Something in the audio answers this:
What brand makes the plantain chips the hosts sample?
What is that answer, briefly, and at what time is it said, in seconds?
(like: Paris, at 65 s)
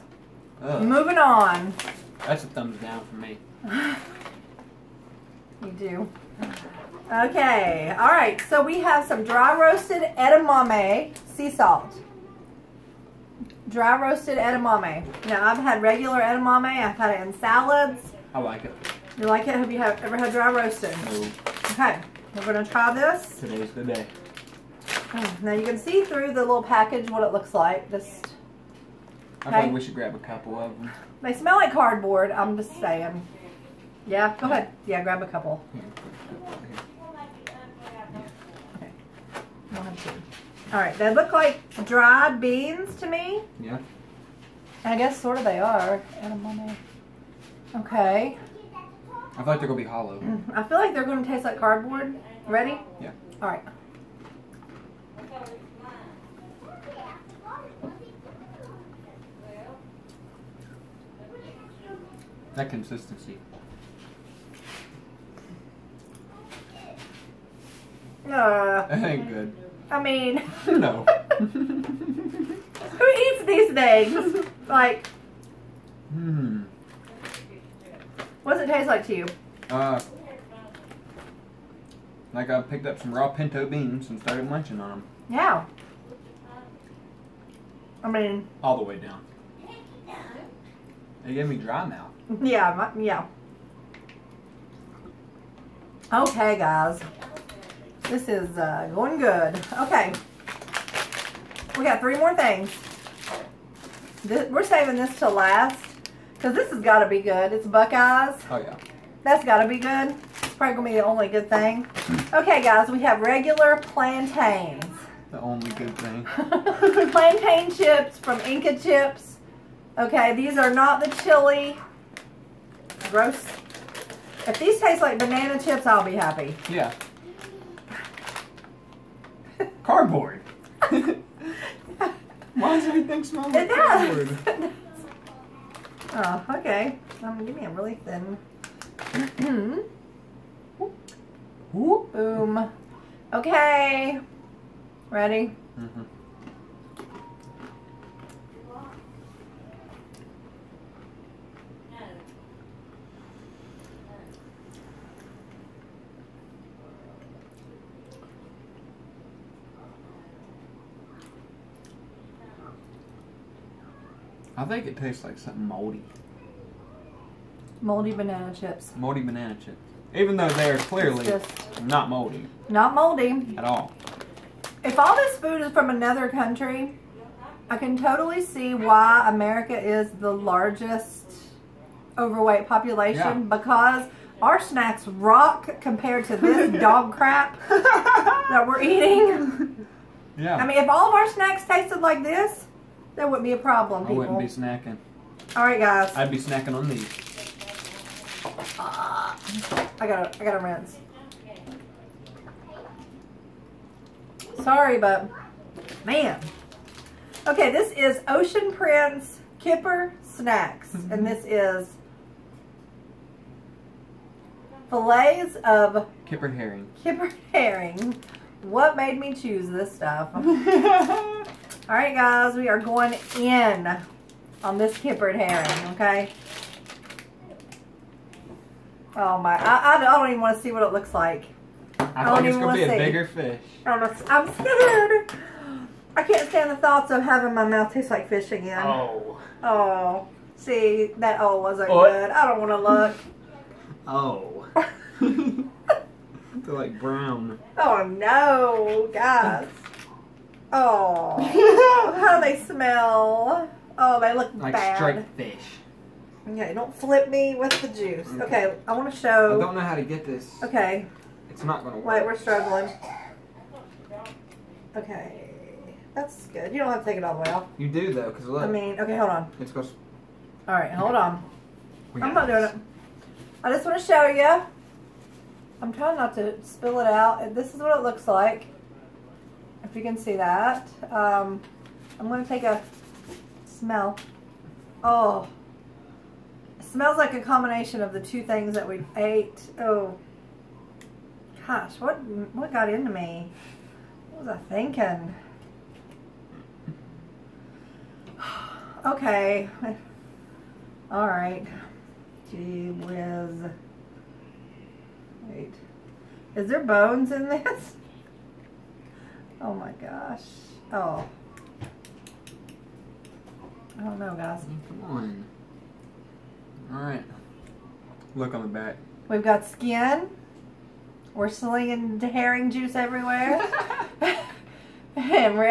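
Inka Chips, at 118 s.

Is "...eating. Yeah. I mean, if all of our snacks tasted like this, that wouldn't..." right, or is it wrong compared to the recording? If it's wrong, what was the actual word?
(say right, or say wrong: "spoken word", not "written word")
right.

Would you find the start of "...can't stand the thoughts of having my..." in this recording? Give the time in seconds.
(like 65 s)
236 s.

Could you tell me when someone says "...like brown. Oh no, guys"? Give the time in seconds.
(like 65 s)
246 s.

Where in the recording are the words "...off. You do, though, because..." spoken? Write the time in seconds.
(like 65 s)
267 s.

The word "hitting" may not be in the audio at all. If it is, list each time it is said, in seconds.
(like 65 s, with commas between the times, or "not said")
not said.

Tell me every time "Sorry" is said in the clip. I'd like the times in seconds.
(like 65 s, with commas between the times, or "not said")
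204 s.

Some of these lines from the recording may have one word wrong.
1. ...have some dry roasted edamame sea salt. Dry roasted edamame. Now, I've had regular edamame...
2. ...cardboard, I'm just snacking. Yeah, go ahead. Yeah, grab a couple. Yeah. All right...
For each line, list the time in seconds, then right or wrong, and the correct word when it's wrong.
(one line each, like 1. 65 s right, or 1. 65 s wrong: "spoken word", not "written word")
1. 8 s right
2. 31 s wrong: "saying", not "snacking".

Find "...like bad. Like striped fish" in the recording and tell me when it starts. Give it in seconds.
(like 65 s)
254 s.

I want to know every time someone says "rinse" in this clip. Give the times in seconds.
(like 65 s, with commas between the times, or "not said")
200 s.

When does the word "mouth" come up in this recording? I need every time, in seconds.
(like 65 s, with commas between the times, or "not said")
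91 s, 237 s.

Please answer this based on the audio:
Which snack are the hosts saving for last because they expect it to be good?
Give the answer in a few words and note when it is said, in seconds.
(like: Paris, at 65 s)
Buckeyes, at 107 s.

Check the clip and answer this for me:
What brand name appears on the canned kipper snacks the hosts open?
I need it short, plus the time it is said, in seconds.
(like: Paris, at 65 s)
Ocean Prince, at 208 s.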